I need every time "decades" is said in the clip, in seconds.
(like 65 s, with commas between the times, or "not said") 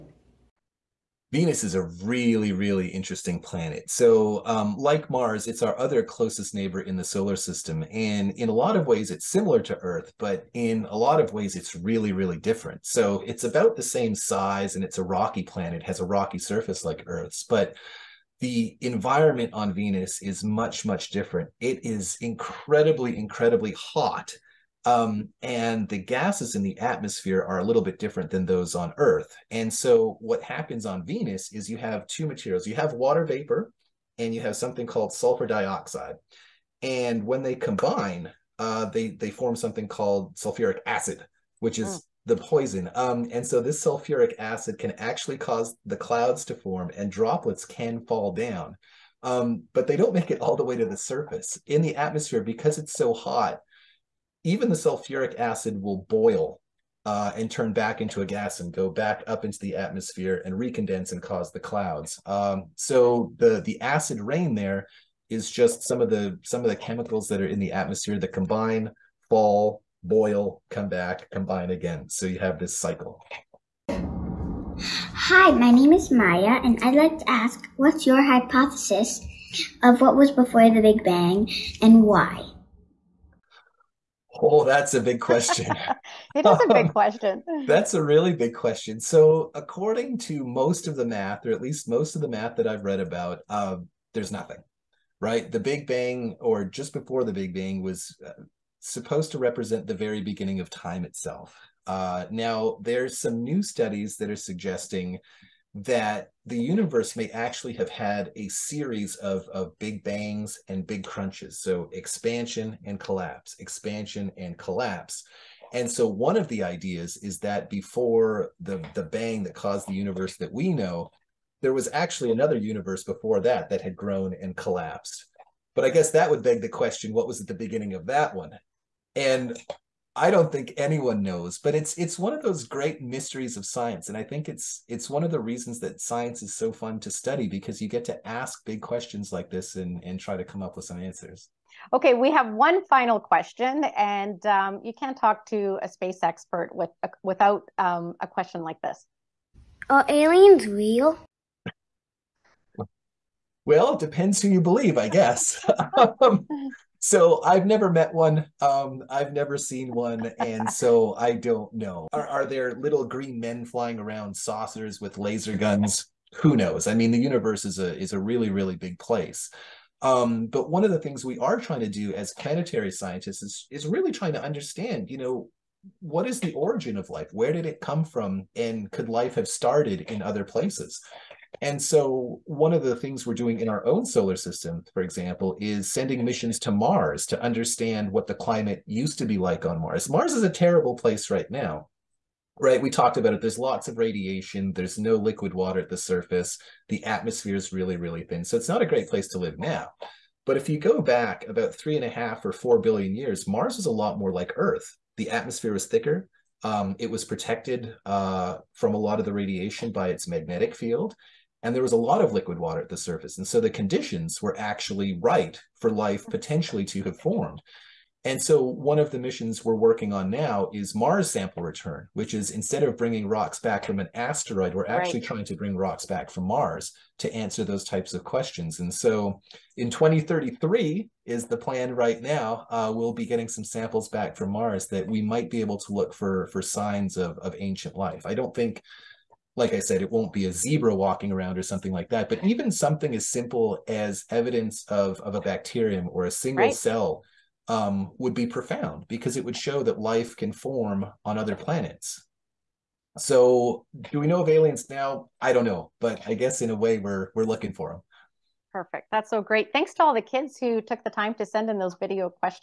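not said.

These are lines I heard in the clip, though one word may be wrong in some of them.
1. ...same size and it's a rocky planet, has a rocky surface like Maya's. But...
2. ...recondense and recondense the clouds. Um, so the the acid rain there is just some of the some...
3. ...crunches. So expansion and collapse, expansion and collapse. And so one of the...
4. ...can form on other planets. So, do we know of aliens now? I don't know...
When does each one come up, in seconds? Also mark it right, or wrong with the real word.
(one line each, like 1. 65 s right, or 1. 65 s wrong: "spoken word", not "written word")
1. 13 s wrong: "Earth", not "Maya"
2. 60 s wrong: "cause", not "recondense"
3. 111 s right
4. 250 s right.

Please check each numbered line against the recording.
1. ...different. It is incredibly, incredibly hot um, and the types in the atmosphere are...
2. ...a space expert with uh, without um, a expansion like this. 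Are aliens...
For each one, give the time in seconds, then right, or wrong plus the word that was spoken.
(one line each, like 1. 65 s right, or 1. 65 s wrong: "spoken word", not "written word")
1. 21 s wrong: "gases", not "types"
2. 145 s wrong: "question", not "expansion".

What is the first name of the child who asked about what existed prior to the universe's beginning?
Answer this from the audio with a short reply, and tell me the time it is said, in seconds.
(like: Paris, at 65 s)
Maya, at 76 s.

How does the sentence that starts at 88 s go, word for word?
So, according to most of the math, or at least most of the math that I've read about, uh, there's nothing, right?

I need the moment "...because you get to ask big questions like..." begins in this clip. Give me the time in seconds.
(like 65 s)
137 s.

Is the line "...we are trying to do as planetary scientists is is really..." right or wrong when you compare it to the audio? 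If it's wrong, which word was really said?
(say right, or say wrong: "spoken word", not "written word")
right.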